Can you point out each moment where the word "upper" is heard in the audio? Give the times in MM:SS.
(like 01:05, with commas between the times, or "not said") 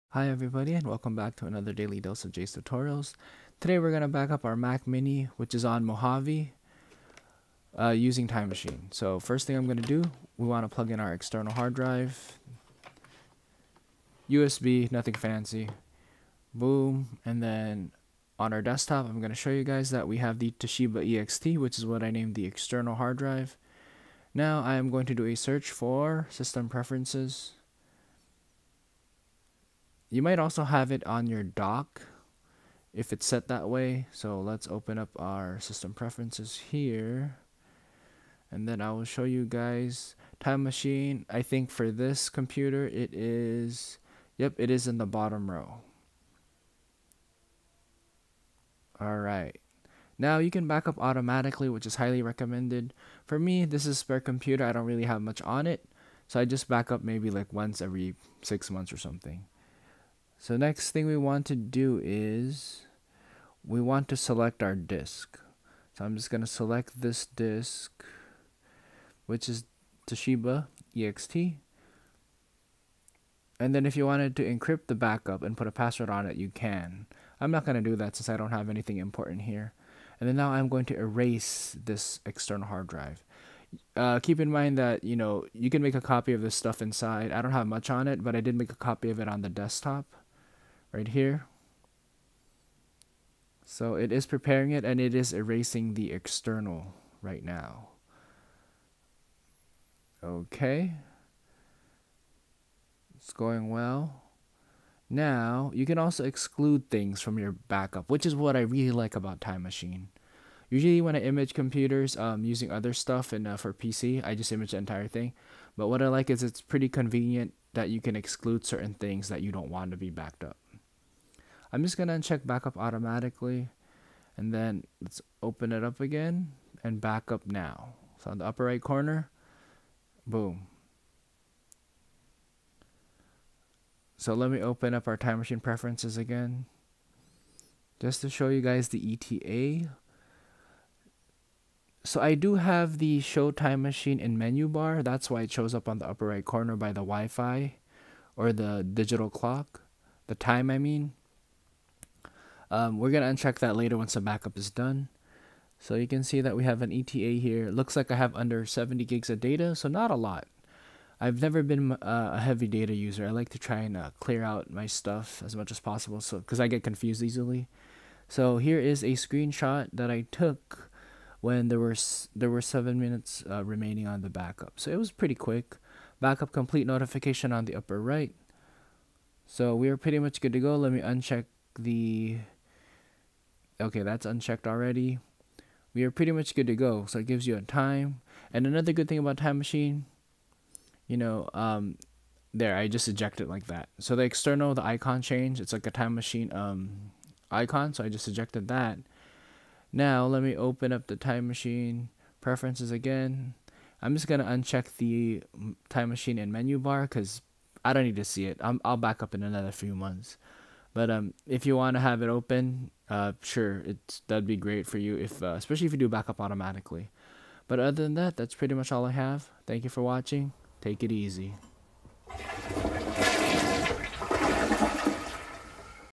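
02:08, 02:26, 02:57.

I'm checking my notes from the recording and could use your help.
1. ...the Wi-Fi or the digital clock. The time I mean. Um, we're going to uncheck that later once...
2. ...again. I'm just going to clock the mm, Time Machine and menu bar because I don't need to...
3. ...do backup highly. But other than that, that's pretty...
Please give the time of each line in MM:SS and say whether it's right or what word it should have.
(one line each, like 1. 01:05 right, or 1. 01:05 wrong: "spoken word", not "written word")
1. 02:26 right
2. 03:22 wrong: "uncheck", not "clock"
3. 03:35 wrong: "automatically", not "highly".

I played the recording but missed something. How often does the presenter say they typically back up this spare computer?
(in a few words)
once every six months.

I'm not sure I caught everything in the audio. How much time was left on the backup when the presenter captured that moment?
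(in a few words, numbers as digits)
7 minutes.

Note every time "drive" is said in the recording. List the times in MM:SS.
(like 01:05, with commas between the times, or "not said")
00:11, 00:23, 01:22.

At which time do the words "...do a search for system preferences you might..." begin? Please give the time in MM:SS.
00:25.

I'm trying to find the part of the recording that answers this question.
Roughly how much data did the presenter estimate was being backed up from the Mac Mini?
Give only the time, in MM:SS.
02:38.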